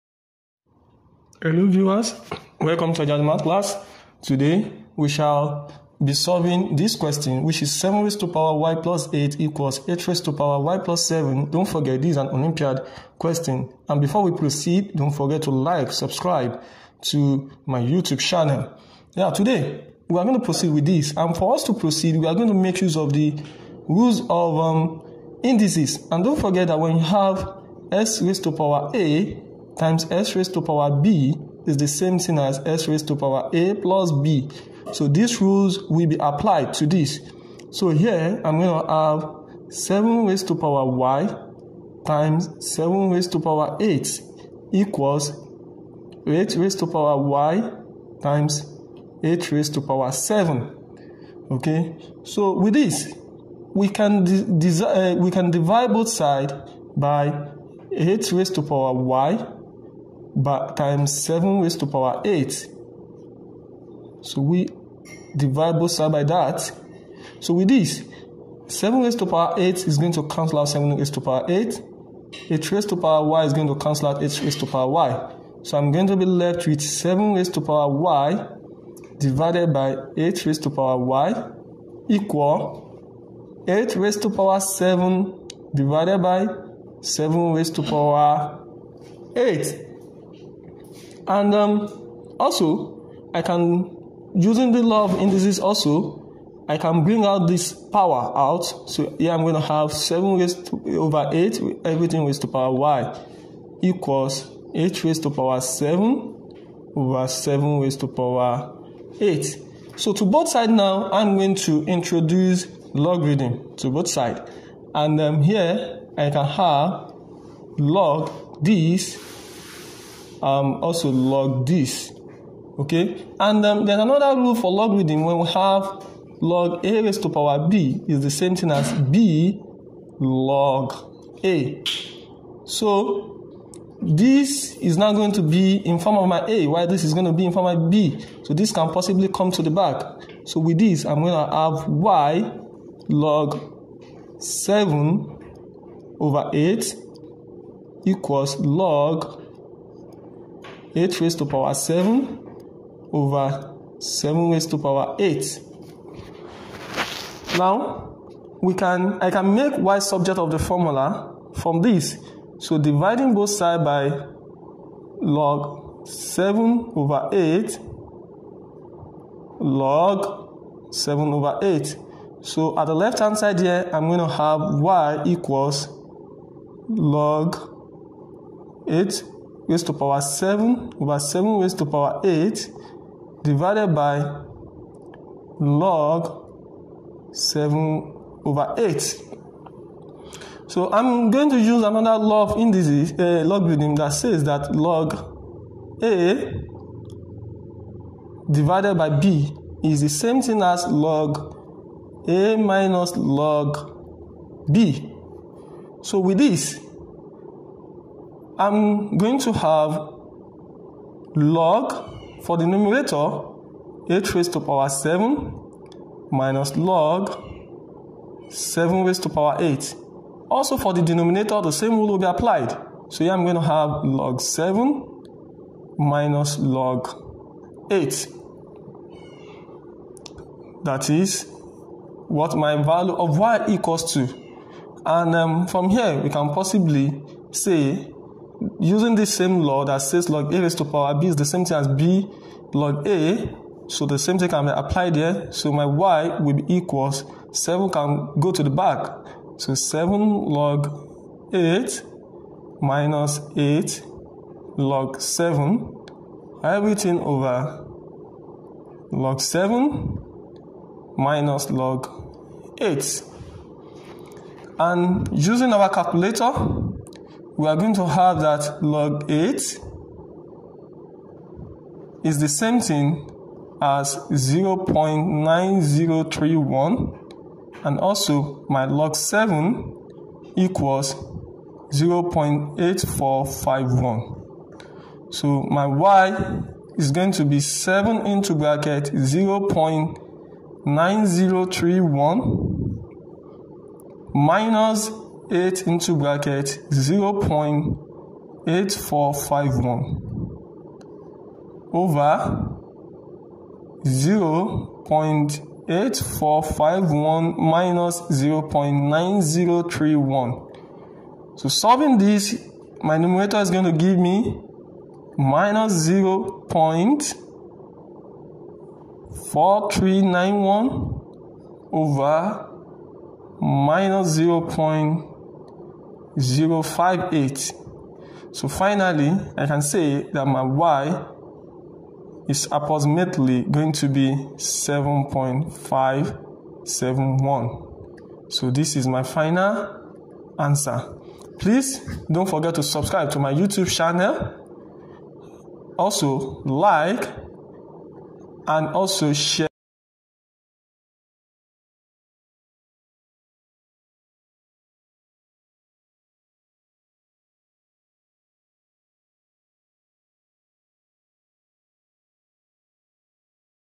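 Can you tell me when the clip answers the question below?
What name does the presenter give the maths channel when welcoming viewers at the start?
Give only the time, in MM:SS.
00:03.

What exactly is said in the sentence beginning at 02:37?
Now, we can, I can make y subject of the formula from this.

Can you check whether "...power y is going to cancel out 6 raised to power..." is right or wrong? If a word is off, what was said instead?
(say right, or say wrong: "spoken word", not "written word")
wrong: "8", not "6".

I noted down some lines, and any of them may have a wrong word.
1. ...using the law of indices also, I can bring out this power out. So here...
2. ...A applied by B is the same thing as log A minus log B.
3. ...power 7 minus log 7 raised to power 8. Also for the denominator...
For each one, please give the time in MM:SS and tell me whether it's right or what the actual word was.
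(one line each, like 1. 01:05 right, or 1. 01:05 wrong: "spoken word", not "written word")
1. 01:34 right
2. 03:16 wrong: "divided", not "applied"
3. 03:34 right.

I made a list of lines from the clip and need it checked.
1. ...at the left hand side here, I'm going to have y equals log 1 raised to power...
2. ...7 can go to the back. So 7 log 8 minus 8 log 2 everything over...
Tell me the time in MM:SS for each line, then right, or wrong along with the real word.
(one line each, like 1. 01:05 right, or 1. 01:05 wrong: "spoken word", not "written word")
1. 02:52 wrong: "8", not "1"
2. 04:07 wrong: "7", not "2".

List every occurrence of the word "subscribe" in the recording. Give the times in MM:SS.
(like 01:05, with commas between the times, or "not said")
00:15, 05:42.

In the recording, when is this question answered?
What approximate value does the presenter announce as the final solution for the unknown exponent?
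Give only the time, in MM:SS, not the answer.
05:34.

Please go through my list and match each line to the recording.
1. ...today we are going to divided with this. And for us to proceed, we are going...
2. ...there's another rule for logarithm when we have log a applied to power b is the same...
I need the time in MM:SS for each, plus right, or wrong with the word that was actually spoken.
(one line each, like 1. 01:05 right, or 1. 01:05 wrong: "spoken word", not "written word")
1. 00:19 wrong: "proceed", not "divided"
2. 02:03 wrong: "raised", not "applied".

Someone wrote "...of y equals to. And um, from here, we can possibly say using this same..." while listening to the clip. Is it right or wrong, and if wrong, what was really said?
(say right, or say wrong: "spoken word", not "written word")
right.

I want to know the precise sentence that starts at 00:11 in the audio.
Don't forget this is an Olympiad question.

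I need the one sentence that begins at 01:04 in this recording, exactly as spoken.
So we divide both side by that.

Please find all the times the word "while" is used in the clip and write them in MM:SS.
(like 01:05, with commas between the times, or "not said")
02:16.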